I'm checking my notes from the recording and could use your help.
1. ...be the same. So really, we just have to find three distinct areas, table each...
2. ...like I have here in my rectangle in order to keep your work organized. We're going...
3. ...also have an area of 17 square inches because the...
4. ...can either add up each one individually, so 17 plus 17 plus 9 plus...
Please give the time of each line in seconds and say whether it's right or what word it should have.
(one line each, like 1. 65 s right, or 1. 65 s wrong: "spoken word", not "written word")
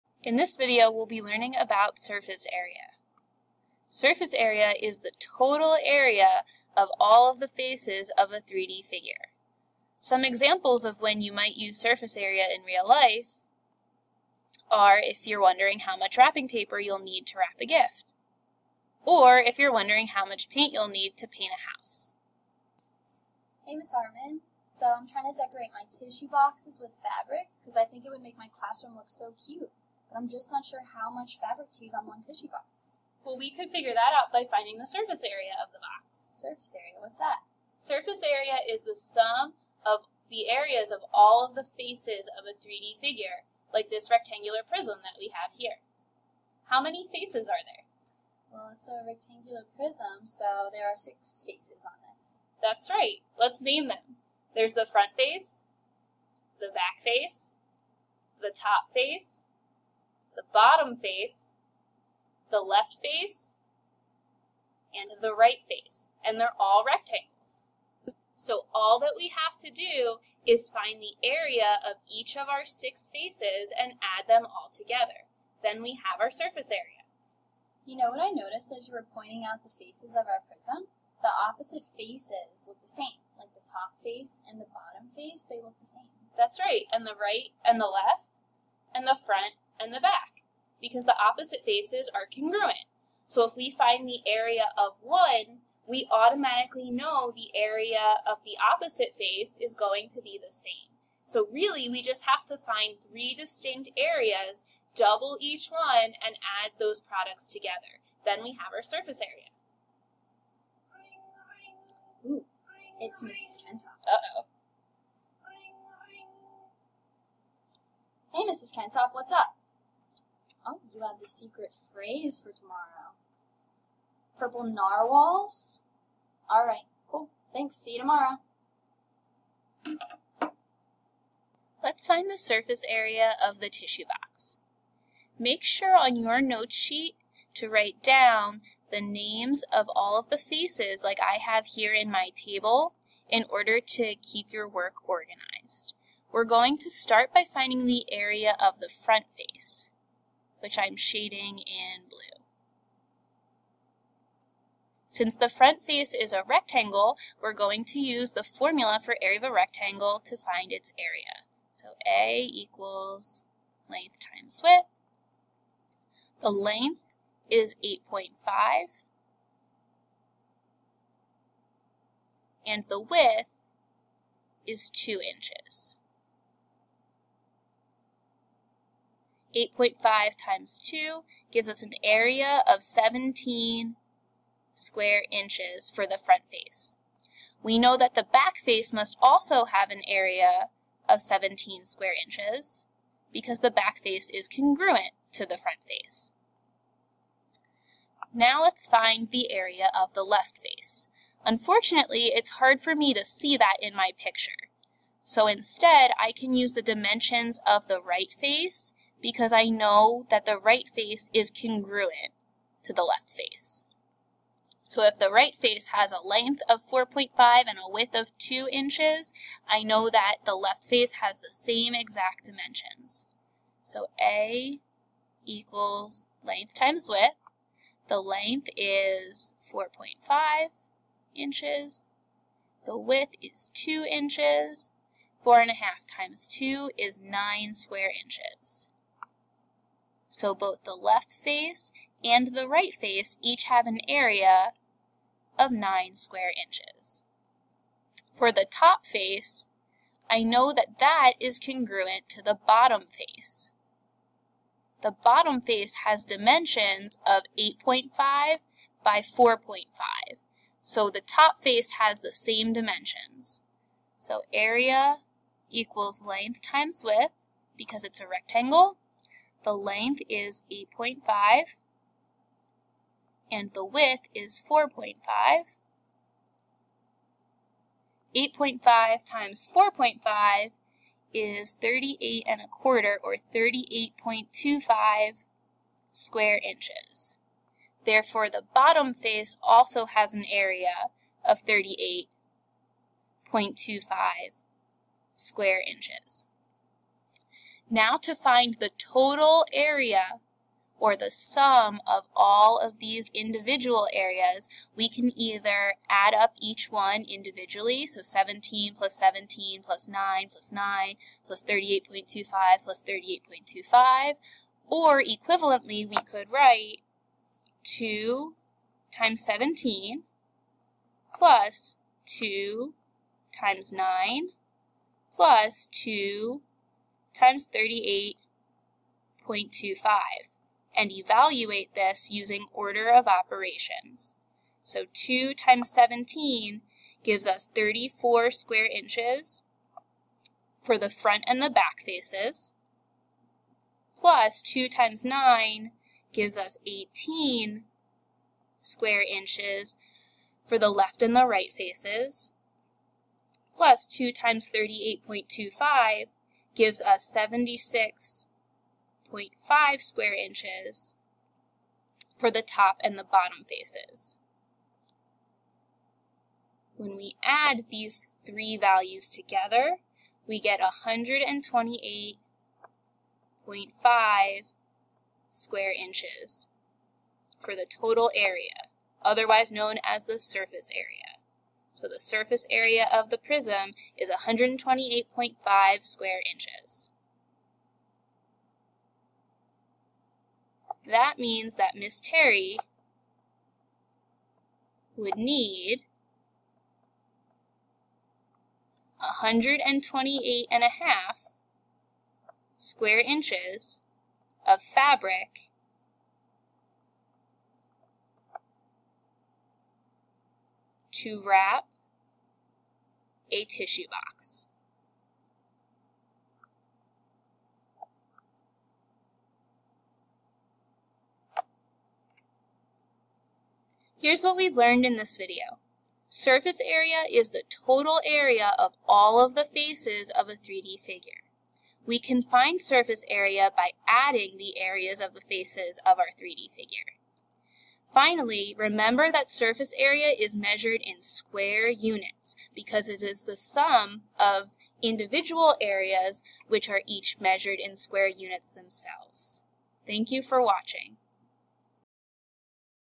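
1. 100 s wrong: "double", not "table"
2. 141 s wrong: "table", not "rectangle"
3. 189 s right
4. 305 s right.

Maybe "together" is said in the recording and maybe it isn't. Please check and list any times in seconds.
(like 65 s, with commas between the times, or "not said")
74 s, 107 s, 369 s.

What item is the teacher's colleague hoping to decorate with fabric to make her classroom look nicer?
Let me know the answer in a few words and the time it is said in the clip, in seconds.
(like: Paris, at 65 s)
tissue boxes, at 25 s.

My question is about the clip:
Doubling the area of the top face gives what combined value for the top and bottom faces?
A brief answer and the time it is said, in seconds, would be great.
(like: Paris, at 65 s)
76.5 square inches, at 357 s.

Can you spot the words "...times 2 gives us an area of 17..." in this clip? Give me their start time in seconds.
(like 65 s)
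180 s.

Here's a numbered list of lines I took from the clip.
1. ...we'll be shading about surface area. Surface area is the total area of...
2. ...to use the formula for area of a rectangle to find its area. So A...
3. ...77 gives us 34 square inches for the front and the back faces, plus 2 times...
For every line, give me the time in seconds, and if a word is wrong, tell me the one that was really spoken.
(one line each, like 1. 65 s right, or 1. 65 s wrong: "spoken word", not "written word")
1. 0 s wrong: "learning", not "shading"
2. 157 s right
3. 335 s wrong: "17", not "77".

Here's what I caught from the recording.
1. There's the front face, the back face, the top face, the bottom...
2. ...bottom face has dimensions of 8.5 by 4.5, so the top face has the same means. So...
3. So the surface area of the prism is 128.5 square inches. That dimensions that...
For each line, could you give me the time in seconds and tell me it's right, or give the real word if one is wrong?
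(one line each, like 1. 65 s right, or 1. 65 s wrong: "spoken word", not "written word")
1. 54 s right
2. 255 s wrong: "dimensions", not "means"
3. 381 s wrong: "means", not "dimensions".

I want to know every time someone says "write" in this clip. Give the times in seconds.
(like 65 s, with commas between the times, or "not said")
137 s, 316 s.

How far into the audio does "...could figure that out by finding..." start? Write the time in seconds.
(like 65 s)
33 s.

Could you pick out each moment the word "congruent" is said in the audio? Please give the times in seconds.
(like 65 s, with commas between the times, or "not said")
92 s, 194 s, 211 s, 251 s.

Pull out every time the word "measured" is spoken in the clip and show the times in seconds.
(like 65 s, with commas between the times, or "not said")
440 s, 447 s.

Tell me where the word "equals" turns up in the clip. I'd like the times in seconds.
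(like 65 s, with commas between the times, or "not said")
162 s, 225 s, 265 s.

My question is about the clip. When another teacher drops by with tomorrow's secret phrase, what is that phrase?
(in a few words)
Purple narwhals.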